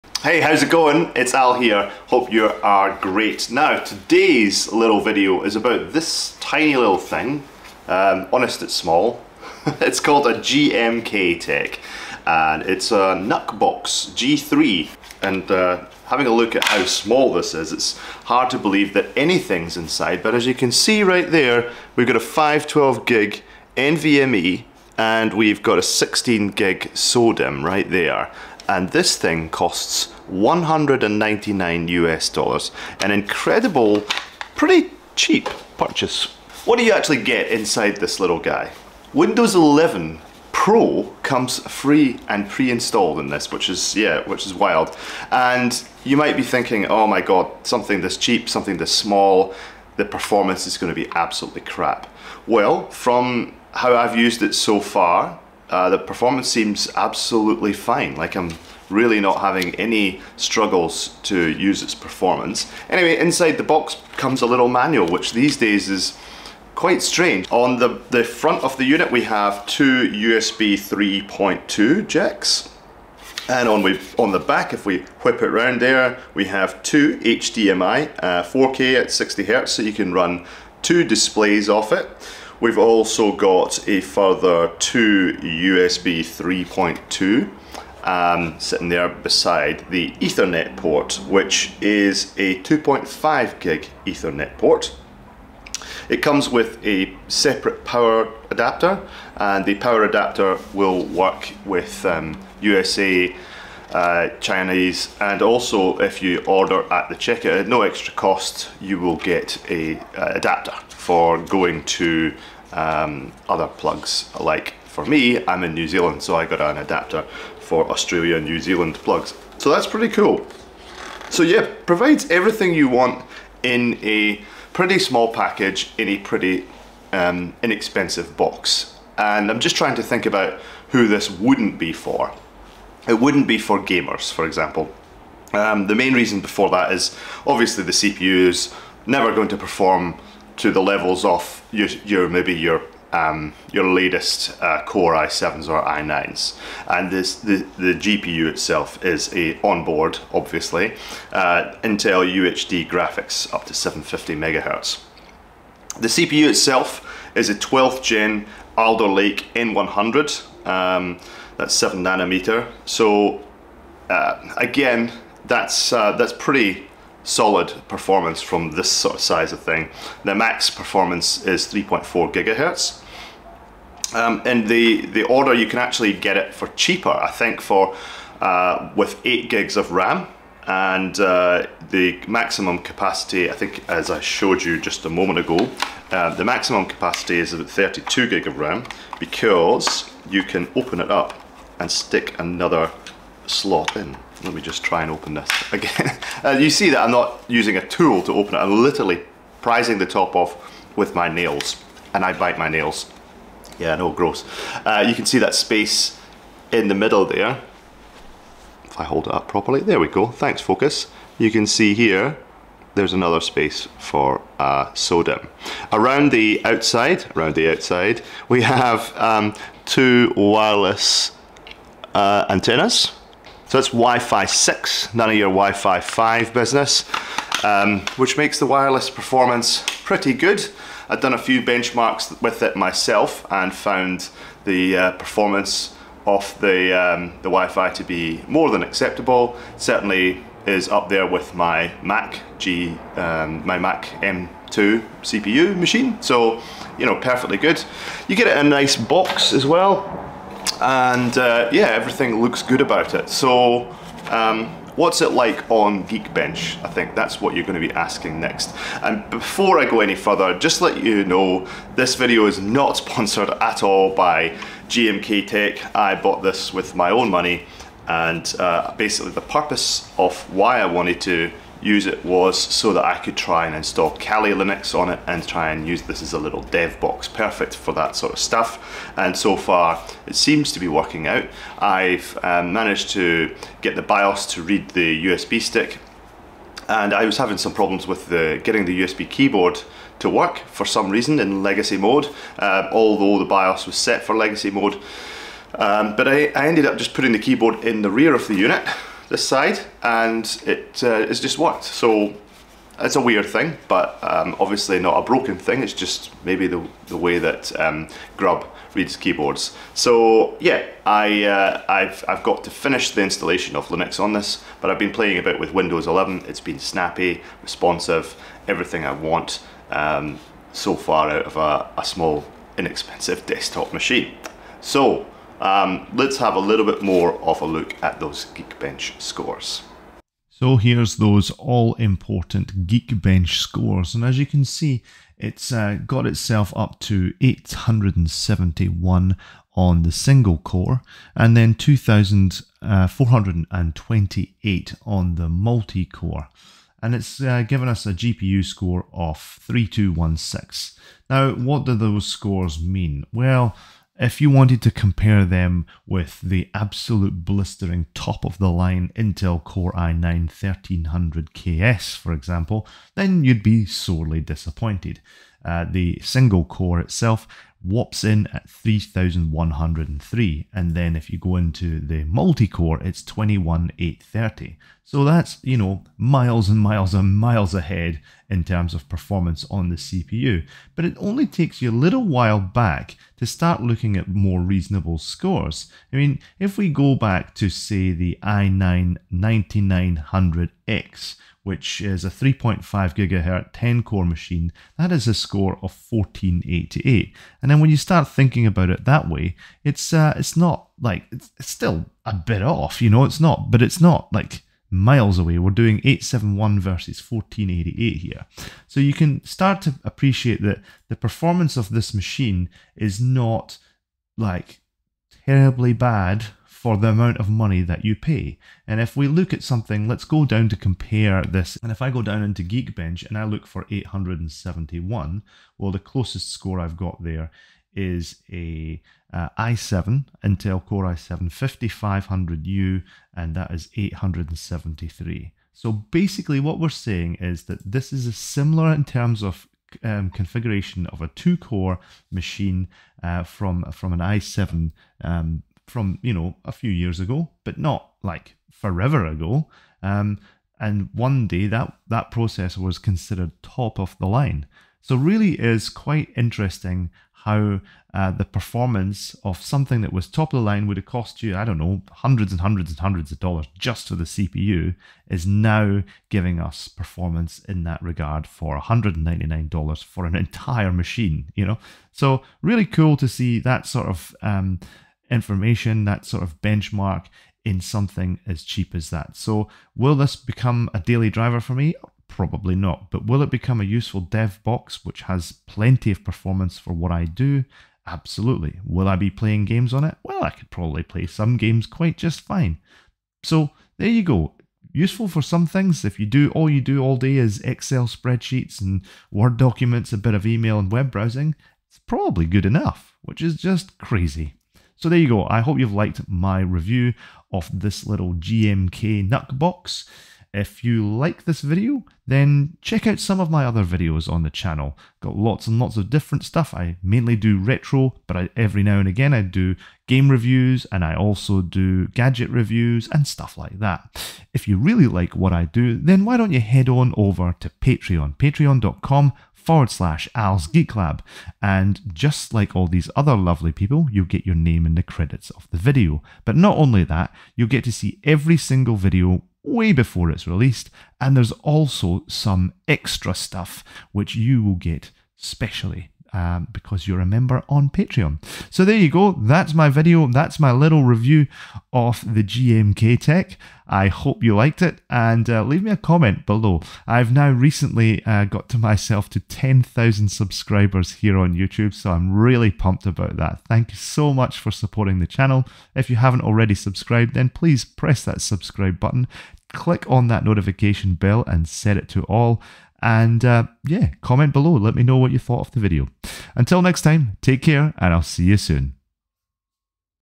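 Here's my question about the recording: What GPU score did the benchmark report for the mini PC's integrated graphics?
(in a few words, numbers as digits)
3216.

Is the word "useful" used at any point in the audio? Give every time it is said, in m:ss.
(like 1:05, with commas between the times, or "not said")
8:03, 8:14.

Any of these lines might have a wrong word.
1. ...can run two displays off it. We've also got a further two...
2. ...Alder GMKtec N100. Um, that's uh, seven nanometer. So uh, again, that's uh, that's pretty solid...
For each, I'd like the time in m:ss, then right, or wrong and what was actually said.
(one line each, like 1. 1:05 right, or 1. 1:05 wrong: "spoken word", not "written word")
1. 1:19 right
2. 2:38 wrong: "Lake", not "GMKtec".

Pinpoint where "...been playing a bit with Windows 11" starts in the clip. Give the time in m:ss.
5:14.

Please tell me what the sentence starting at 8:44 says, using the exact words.
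If you really like what I do, then why don't you head on over to Patreon, patreon.com forward slash Al's Geek Lab.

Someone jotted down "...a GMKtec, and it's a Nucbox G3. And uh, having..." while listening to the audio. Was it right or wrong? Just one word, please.
right.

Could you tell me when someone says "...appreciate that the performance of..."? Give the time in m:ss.
6:50.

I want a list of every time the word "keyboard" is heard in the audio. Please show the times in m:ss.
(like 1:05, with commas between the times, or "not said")
4:49, 4:57, 5:09.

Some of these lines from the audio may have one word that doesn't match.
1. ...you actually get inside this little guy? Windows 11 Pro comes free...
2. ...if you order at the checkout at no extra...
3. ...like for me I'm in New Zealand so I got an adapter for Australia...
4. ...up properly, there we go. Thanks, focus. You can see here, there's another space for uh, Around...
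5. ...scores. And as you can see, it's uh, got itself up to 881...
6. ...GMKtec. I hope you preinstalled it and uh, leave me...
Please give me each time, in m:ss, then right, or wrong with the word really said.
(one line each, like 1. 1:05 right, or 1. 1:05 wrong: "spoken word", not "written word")
1. 0:36 right
2. 1:45 right
3. 1:54 right
4. 3:29 right
5. 5:33 wrong: "871", not "881"
6. 9:12 wrong: "liked", not "preinstalled".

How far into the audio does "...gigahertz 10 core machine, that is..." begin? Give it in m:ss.
6:33.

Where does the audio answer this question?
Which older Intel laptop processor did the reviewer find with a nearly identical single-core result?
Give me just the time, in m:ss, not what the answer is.
7:10.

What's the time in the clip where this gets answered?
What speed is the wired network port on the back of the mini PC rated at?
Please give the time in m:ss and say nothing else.
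1:32.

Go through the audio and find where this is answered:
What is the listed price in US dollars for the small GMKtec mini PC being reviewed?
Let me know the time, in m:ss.
0:30.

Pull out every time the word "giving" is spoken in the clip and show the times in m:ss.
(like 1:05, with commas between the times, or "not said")
7:46.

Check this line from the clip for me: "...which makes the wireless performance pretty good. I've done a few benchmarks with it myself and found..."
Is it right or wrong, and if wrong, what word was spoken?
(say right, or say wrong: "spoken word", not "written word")
right.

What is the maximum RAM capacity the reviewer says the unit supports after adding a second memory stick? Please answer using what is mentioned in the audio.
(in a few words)
32 gig.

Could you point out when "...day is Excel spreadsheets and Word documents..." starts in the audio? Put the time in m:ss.
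8:17.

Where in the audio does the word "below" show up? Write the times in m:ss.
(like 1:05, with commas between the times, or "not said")
9:16, 9:34.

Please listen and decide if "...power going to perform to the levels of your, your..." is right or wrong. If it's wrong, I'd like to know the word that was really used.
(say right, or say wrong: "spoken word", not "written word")
wrong: "never", not "power".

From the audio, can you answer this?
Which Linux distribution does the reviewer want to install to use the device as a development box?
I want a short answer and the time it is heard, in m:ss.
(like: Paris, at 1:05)
Kali Linux, at 4:34.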